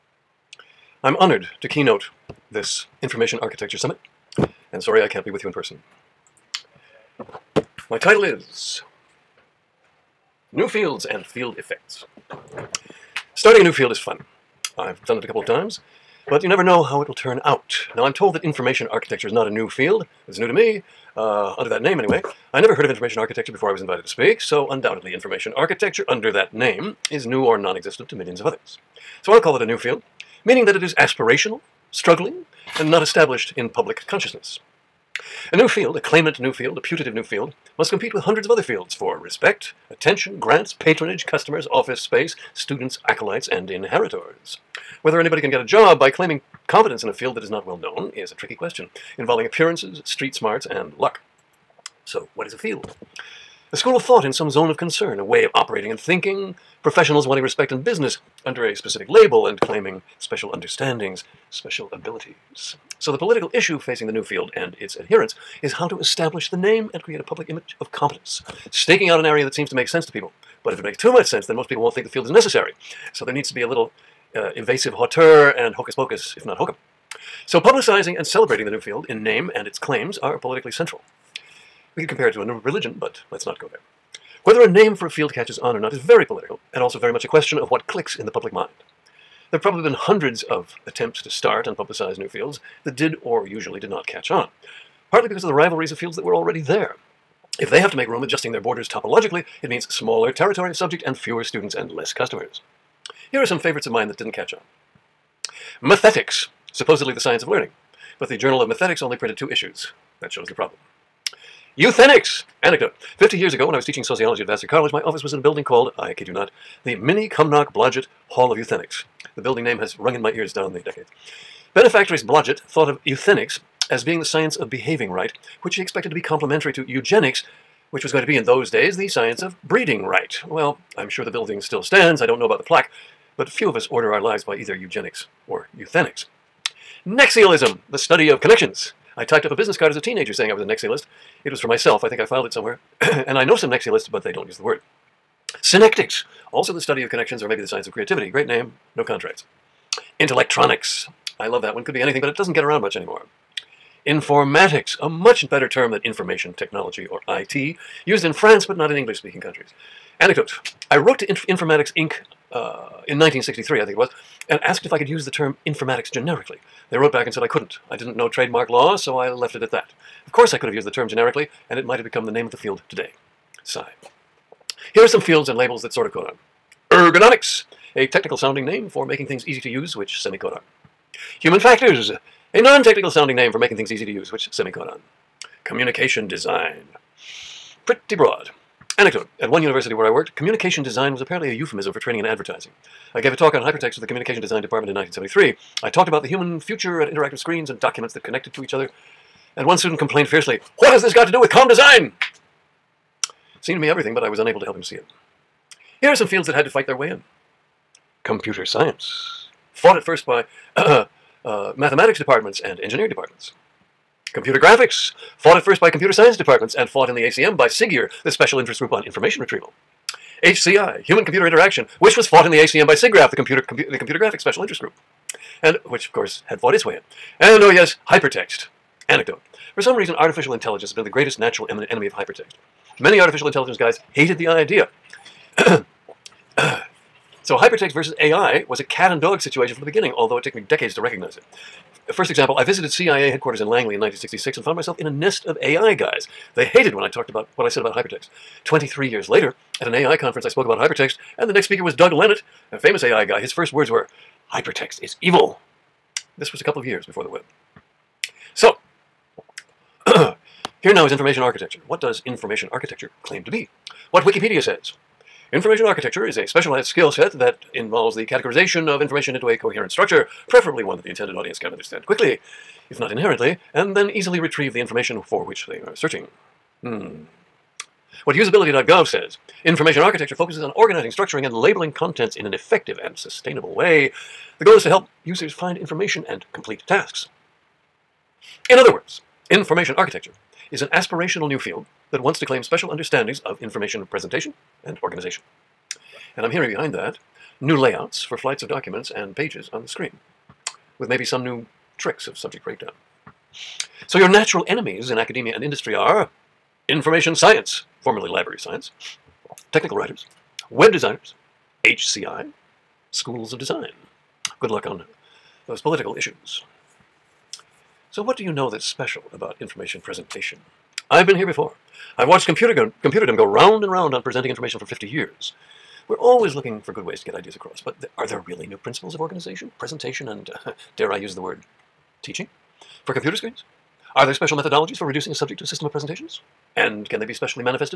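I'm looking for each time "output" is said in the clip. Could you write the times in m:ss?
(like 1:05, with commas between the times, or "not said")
not said.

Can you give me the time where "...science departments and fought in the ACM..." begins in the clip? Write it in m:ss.
3:36.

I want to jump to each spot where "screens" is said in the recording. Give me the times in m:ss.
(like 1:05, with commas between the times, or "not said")
3:17, 4:59, 5:33.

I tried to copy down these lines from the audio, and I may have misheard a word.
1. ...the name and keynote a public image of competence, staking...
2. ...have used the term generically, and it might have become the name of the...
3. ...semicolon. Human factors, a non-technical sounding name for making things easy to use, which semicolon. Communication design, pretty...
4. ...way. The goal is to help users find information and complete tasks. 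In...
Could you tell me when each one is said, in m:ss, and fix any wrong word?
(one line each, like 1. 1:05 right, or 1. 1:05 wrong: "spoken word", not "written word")
1. 1:06 wrong: "create", not "keynote"
2. 2:50 right
3. 3:00 right
4. 4:43 right.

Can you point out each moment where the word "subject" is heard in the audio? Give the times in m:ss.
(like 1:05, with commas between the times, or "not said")
1:40, 5:02, 5:35.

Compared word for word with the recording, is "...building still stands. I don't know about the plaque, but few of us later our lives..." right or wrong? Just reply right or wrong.
wrong.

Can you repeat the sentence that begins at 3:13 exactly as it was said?
I gave a talk on hypertext to the Communication Design Department in 1973.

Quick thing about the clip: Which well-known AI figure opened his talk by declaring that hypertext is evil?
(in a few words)
Doug Lenat.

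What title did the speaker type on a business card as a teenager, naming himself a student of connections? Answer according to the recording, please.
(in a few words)
Nexialist.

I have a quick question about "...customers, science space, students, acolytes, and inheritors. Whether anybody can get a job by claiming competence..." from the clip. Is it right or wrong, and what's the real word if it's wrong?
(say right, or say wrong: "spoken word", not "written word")
wrong: "office", not "science".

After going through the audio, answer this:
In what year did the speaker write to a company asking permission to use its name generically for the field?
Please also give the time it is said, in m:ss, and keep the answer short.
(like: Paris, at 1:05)
1963, at 2:43.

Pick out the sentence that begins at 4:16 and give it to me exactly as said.
This was a couple of years before the web.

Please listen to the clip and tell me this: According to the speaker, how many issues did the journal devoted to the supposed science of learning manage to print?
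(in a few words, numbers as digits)
2.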